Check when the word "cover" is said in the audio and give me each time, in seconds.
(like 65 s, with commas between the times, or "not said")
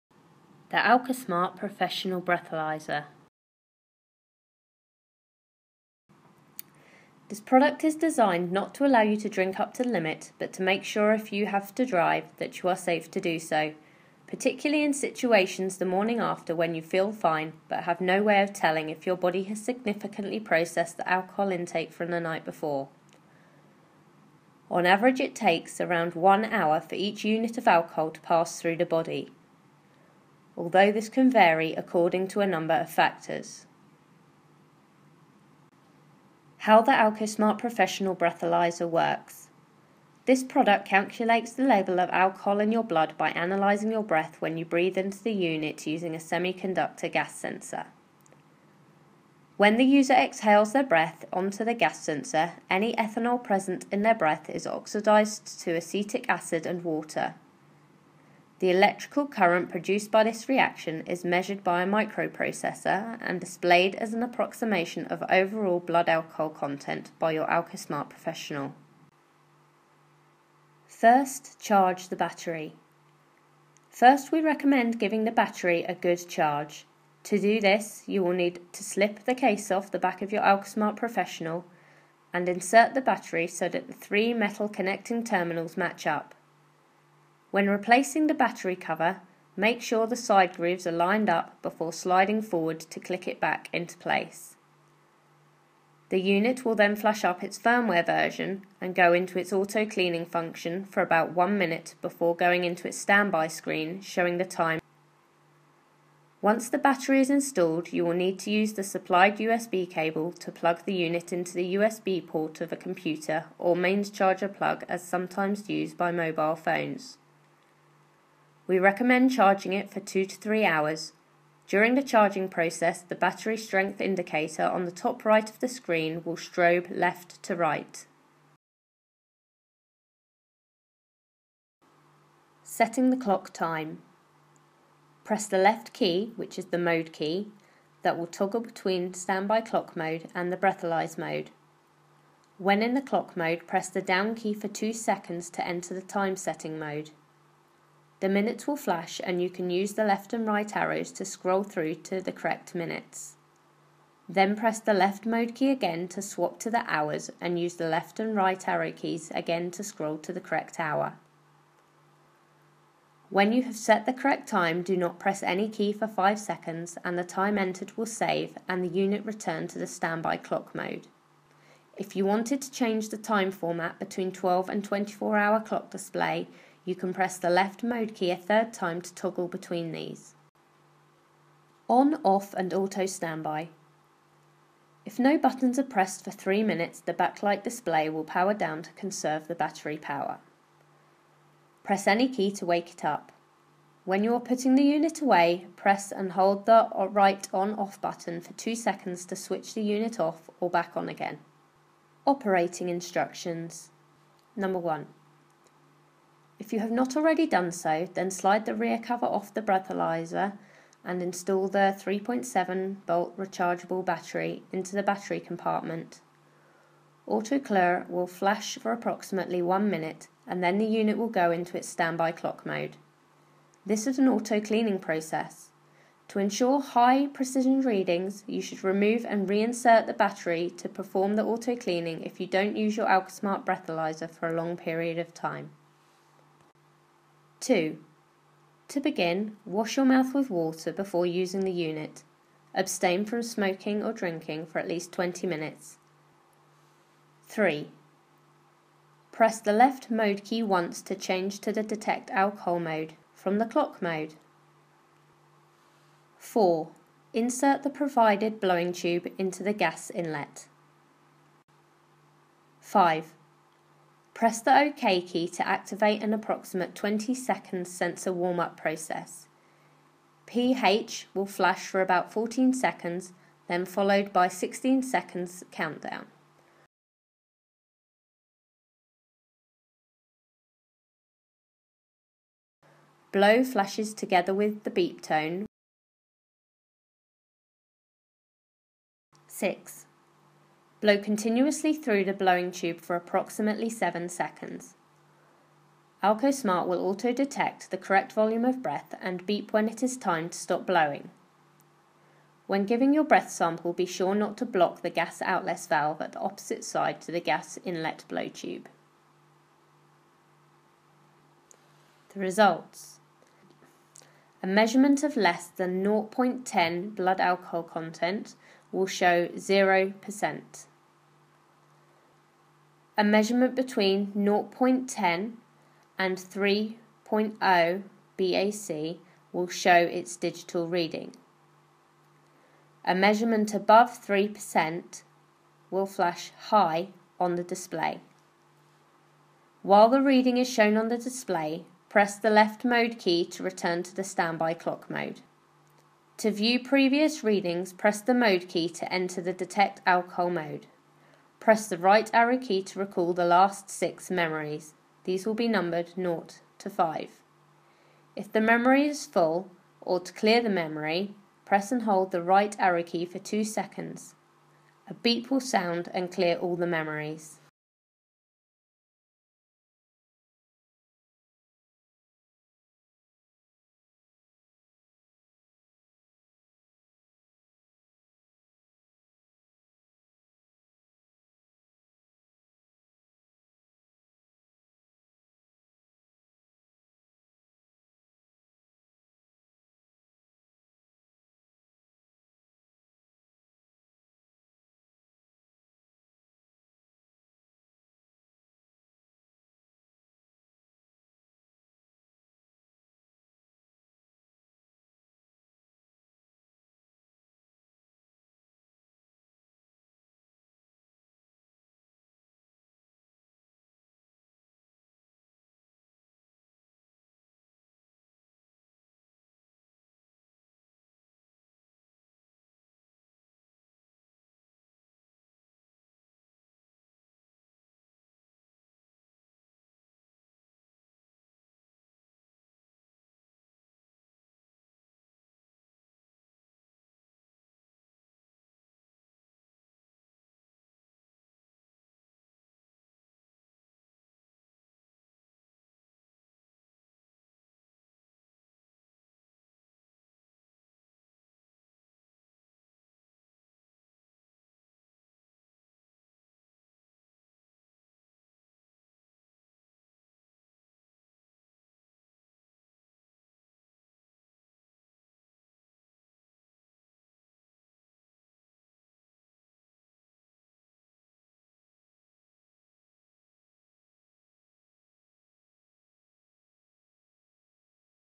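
88 s, 209 s.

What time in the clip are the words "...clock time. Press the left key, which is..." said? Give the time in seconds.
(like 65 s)
133 s.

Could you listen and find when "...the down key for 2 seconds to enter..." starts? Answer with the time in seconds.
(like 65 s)
143 s.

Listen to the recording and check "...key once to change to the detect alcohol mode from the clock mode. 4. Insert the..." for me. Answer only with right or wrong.
right.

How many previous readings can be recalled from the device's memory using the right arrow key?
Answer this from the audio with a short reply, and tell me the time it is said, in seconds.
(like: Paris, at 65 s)
6, at 353 s.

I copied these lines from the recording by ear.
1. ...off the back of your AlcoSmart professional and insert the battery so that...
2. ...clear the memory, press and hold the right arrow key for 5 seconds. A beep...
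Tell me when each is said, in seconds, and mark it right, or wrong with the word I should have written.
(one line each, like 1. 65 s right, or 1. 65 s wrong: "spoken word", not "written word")
1. 79 s right
2. 360 s wrong: "2", not "5".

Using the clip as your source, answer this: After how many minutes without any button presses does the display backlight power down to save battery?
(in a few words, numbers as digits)
3 minutes.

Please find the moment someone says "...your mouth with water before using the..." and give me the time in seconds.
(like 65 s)
239 s.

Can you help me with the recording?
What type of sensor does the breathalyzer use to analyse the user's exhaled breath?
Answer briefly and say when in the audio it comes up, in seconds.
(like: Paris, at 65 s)
semiconductor gas sensor, at 46 s.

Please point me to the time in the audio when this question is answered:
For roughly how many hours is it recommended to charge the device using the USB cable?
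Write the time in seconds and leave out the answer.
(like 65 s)
119 s.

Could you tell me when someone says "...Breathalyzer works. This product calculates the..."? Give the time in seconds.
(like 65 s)
38 s.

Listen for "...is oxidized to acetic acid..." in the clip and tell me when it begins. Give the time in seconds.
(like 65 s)
54 s.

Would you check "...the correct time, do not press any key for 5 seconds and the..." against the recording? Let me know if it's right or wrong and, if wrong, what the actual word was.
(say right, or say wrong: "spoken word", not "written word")
right.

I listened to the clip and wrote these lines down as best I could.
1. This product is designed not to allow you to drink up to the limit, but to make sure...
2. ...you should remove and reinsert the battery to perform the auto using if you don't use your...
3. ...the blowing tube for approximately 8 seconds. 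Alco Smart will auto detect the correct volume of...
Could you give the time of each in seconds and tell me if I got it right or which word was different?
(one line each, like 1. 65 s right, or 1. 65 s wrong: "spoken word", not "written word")
1. 7 s right
2. 228 s wrong: "cleaning", not "using"
3. 292 s wrong: "7", not "8".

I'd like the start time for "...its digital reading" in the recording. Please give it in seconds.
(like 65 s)
329 s.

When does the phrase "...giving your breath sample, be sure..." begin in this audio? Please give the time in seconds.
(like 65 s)
302 s.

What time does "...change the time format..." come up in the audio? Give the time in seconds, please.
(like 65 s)
172 s.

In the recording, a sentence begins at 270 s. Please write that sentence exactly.
pH will flash for about 14 seconds, then followed by 16 seconds countdown.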